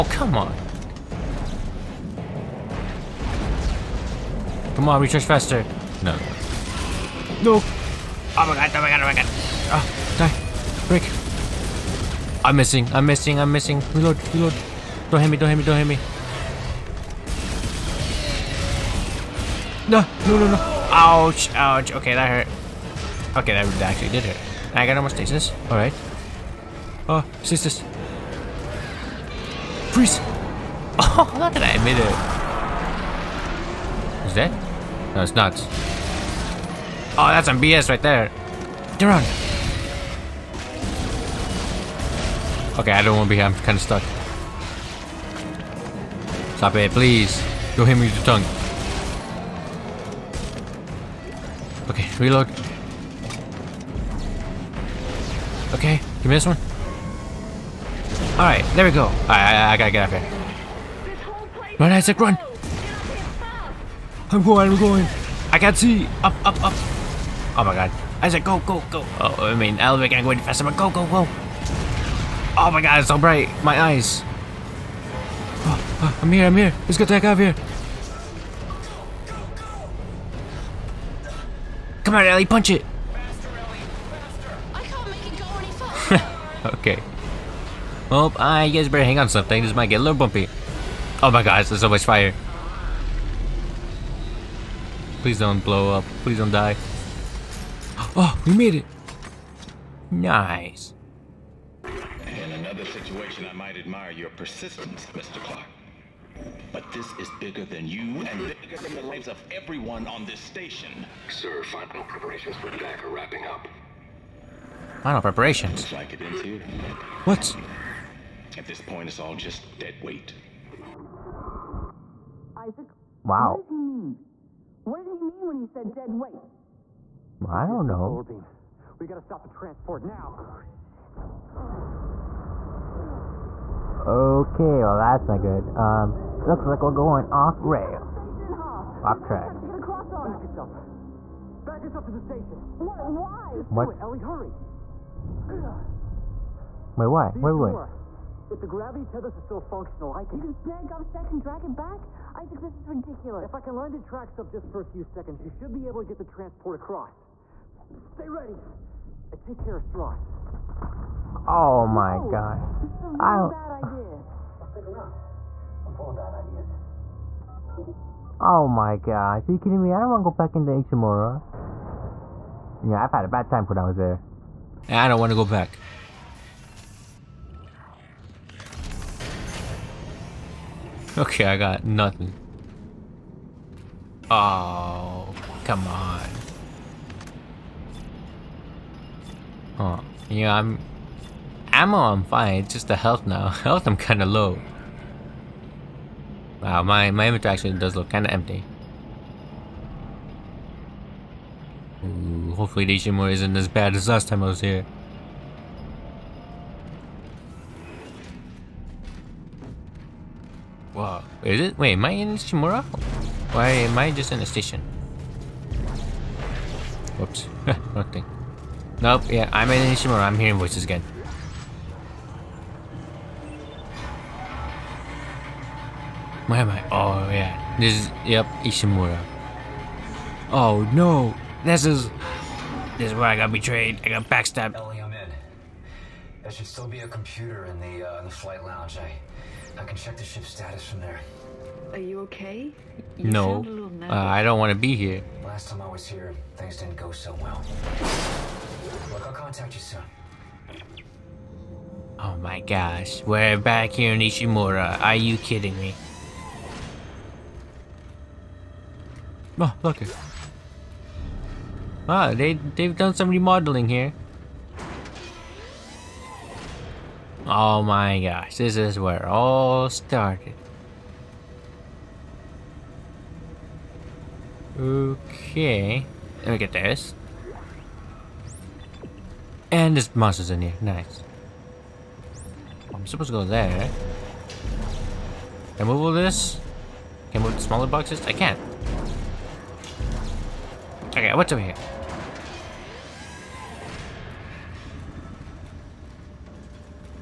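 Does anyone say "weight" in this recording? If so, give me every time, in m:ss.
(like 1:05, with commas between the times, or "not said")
2:00, 2:06.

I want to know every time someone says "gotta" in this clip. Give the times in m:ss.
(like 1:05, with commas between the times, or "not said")
0:59, 2:09.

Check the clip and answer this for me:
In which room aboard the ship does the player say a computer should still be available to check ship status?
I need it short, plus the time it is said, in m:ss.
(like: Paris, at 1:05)
flight lounge, at 3:58.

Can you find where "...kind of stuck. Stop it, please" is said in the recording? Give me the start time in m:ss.
0:43.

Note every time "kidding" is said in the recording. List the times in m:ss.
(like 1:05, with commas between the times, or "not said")
2:49, 4:15.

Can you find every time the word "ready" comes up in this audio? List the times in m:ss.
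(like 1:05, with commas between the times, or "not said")
2:38.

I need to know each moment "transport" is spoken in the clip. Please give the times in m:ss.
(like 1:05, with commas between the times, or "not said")
2:09, 2:36.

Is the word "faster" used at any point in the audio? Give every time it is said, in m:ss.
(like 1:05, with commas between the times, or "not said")
0:05, 1:10.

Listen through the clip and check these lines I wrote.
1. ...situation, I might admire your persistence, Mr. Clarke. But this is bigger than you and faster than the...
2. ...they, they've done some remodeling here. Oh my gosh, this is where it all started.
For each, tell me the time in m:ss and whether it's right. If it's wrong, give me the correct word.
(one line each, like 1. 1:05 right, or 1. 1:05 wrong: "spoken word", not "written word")
1. 1:42 wrong: "bigger", not "faster"
2. 4:22 right.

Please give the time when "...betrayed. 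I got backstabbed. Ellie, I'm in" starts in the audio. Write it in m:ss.
3:53.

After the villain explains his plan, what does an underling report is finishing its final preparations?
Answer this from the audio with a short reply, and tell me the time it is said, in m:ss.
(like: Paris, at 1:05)
DAC, at 1:52.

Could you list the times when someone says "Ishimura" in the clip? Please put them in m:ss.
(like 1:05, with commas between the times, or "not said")
2:50, 3:39, 3:48, 4:14.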